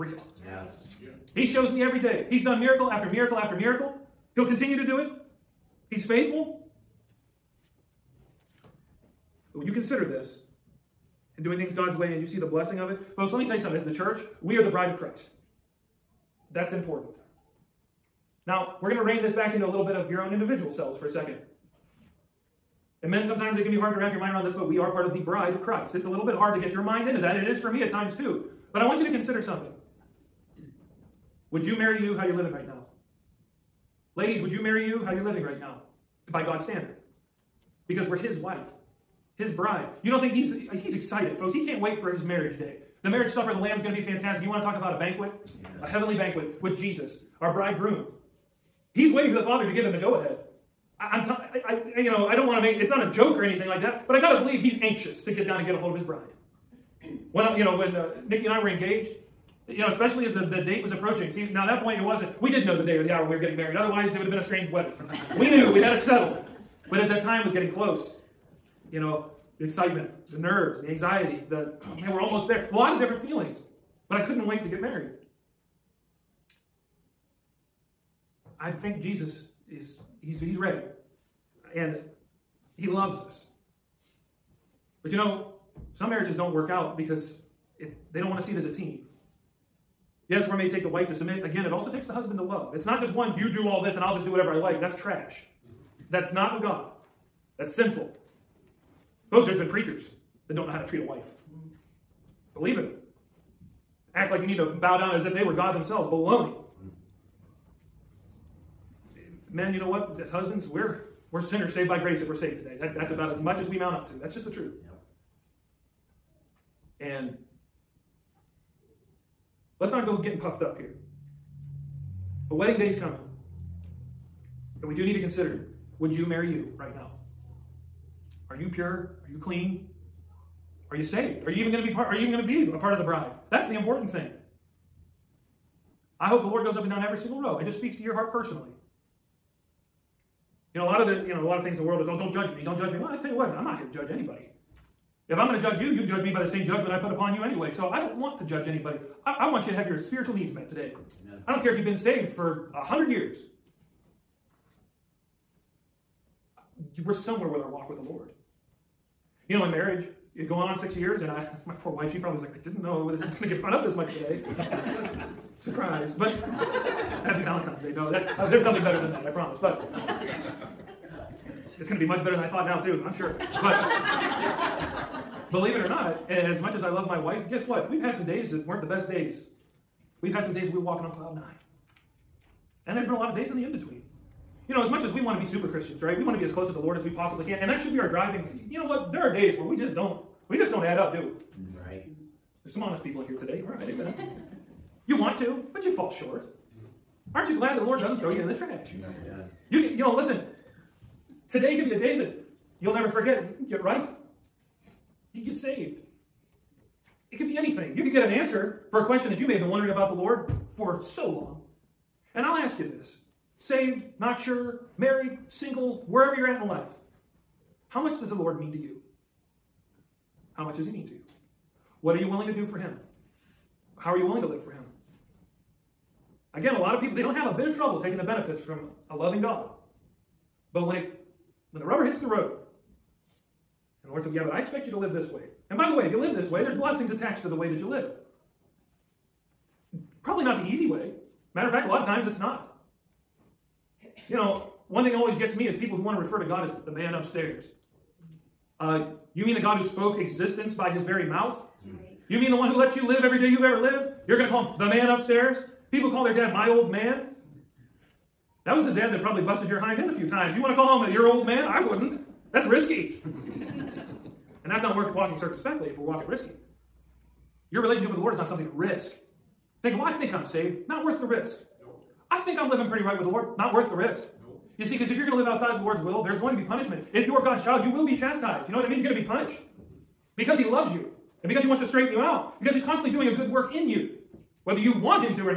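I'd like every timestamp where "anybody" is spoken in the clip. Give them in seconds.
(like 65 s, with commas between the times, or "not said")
144 s, 148 s.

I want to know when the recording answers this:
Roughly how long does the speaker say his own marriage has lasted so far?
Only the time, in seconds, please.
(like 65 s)
160 s.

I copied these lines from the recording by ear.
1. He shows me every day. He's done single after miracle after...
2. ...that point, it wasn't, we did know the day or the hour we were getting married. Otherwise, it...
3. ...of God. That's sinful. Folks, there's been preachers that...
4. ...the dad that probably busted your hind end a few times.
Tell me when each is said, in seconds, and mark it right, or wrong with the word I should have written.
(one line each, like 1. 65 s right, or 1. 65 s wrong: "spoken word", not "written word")
1. 1 s wrong: "miracle", not "single"
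2. 61 s right
3. 96 s right
4. 258 s right.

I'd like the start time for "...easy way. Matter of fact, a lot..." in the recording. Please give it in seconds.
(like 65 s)
240 s.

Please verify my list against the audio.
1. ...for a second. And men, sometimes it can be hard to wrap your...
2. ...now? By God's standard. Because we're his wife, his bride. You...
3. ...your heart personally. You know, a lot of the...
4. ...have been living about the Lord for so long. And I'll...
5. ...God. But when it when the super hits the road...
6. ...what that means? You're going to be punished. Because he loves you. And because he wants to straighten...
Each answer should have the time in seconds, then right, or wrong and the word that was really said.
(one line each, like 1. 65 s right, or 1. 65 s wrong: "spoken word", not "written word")
1. 20 s right
2. 35 s right
3. 138 s right
4. 209 s wrong: "wondering", not "living"
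5. 229 s wrong: "rubber", not "super"
6. 278 s right.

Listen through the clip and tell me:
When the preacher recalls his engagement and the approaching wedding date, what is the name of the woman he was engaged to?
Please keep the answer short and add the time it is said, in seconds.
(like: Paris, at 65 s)
Nikki, at 58 s.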